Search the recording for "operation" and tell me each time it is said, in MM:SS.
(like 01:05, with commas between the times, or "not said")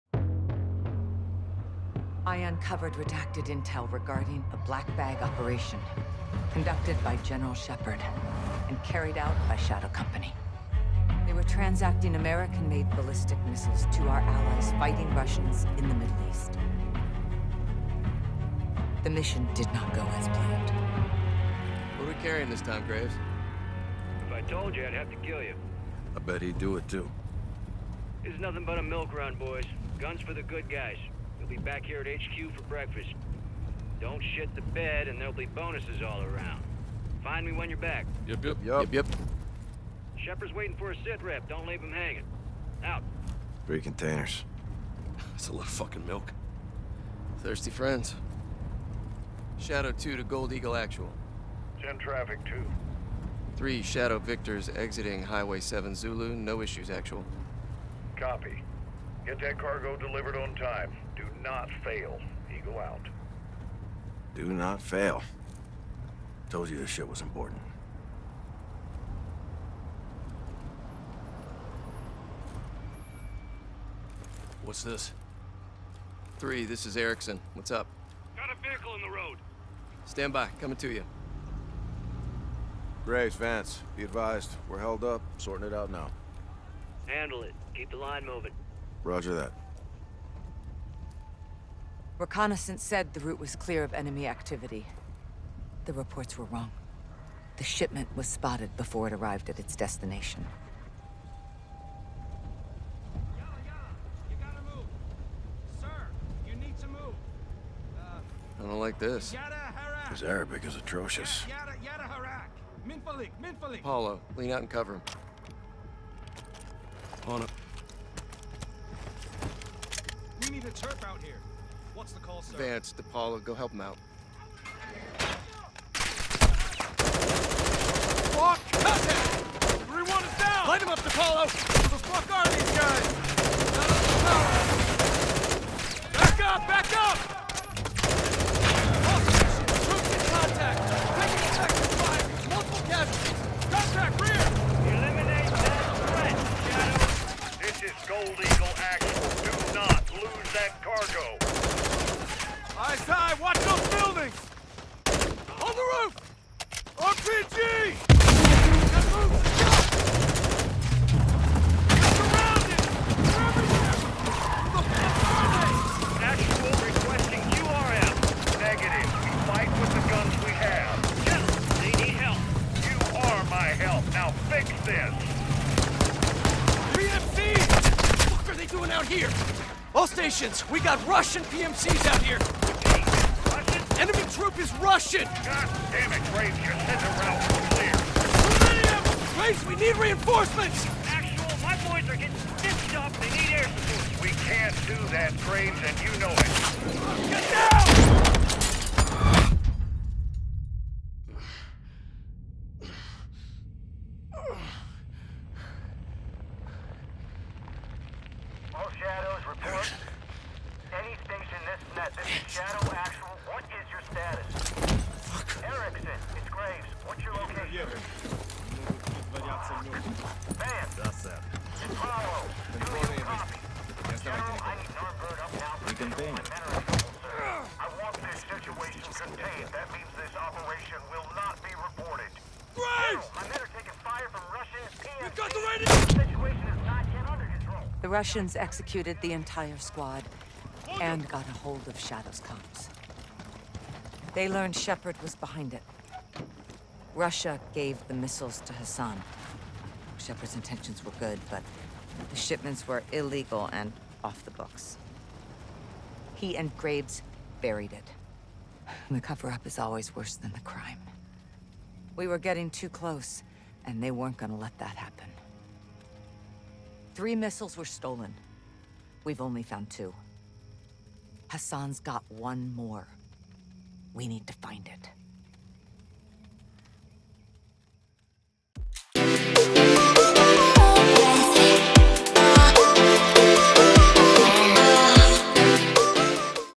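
00:05, 03:50.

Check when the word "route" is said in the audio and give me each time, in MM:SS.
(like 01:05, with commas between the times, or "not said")
01:33, 03:07.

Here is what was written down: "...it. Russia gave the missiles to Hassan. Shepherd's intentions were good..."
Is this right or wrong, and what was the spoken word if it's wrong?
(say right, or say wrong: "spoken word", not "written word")
right.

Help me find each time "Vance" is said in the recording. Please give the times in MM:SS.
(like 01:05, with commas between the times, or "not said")
01:23, 02:02.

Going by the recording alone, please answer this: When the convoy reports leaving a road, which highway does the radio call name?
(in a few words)
Highway 7 Zulu.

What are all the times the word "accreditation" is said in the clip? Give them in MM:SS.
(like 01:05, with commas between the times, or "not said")
not said.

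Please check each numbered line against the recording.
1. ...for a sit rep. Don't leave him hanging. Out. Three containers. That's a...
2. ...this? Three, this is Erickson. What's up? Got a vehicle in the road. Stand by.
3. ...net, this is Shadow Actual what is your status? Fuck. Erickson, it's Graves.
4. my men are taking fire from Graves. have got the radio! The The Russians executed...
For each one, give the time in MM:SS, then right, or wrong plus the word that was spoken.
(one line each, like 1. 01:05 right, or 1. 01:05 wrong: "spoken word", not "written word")
1. 00:40 right
2. 01:14 right
3. 03:31 right
4. 03:53 wrong: "PMC", not "Graves".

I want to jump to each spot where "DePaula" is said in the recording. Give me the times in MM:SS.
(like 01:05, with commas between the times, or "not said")
02:02, 02:10.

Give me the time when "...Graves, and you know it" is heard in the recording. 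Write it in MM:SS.
03:15.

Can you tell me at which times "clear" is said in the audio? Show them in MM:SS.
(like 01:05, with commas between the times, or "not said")
01:33, 03:07.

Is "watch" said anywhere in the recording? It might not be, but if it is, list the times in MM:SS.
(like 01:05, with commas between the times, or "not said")
02:33.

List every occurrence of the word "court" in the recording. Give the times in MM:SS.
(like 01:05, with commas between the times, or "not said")
not said.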